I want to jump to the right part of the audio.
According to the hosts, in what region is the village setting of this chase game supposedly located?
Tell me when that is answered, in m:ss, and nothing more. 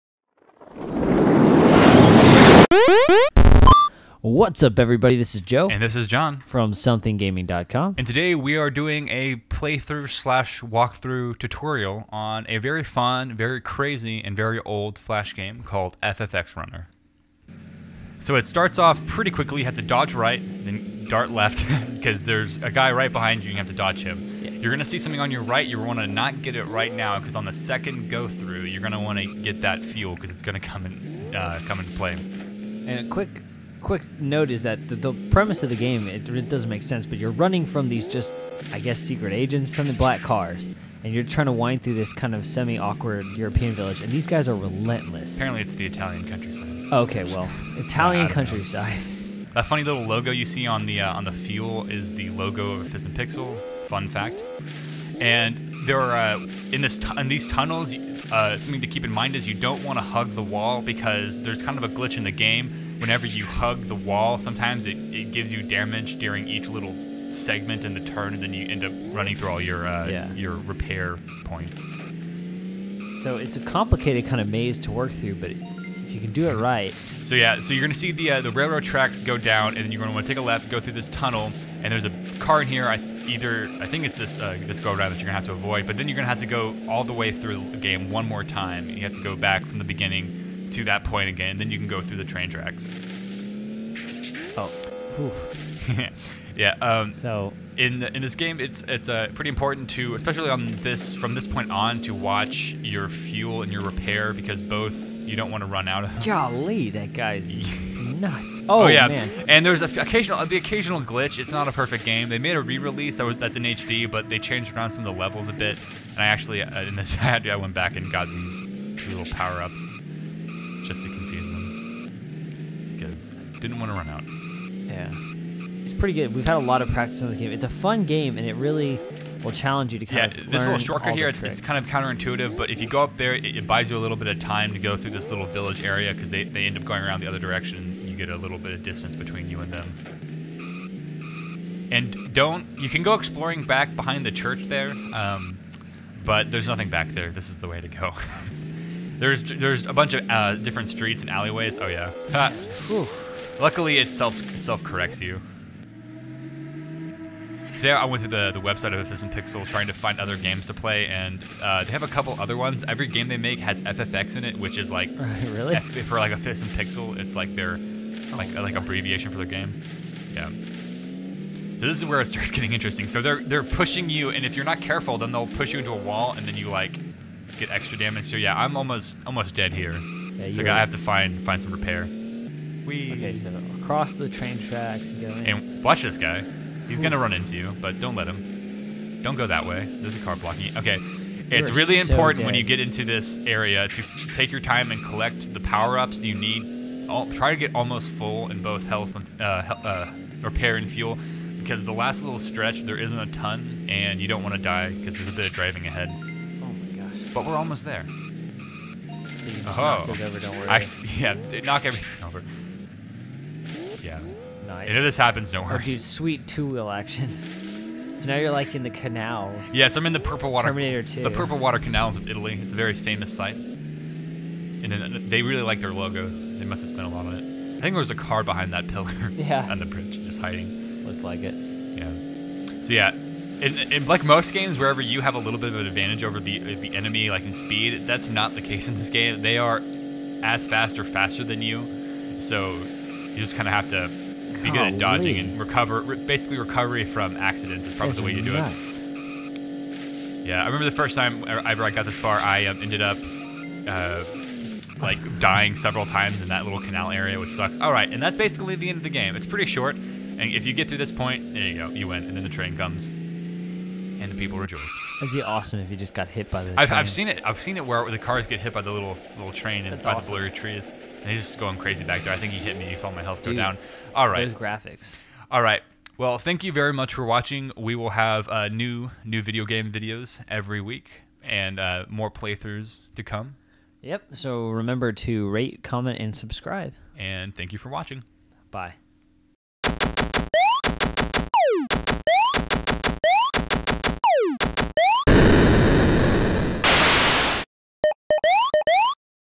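0:45.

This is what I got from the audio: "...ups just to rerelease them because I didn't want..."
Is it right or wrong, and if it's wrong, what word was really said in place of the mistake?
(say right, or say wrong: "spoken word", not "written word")
wrong: "confuse", not "rerelease".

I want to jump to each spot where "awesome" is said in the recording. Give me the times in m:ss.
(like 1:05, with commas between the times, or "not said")
4:25, 4:30.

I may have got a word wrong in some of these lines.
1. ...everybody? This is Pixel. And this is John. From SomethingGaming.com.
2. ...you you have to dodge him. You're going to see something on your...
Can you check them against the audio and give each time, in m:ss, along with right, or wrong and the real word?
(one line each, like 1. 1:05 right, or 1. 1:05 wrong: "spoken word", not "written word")
1. 0:04 wrong: "Joe", not "Pixel"
2. 0:23 right.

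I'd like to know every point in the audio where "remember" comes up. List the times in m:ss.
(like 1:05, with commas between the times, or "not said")
4:10, 4:44.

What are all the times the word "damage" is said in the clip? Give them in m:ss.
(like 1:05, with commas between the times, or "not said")
1:05, 2:57.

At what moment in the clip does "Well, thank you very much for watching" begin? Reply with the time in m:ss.
4:36.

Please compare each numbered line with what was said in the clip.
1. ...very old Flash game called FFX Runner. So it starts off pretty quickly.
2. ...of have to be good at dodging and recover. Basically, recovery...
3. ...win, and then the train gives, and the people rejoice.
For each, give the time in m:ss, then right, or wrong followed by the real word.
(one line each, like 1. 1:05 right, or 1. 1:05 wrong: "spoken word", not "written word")
1. 0:14 right
2. 4:03 right
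3. 4:22 wrong: "comes", not "gives".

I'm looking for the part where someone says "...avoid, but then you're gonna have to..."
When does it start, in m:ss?
1:25.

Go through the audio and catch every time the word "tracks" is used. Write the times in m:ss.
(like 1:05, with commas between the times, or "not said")
1:18, 1:32, 3:04.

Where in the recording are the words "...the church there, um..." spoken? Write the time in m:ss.
2:24.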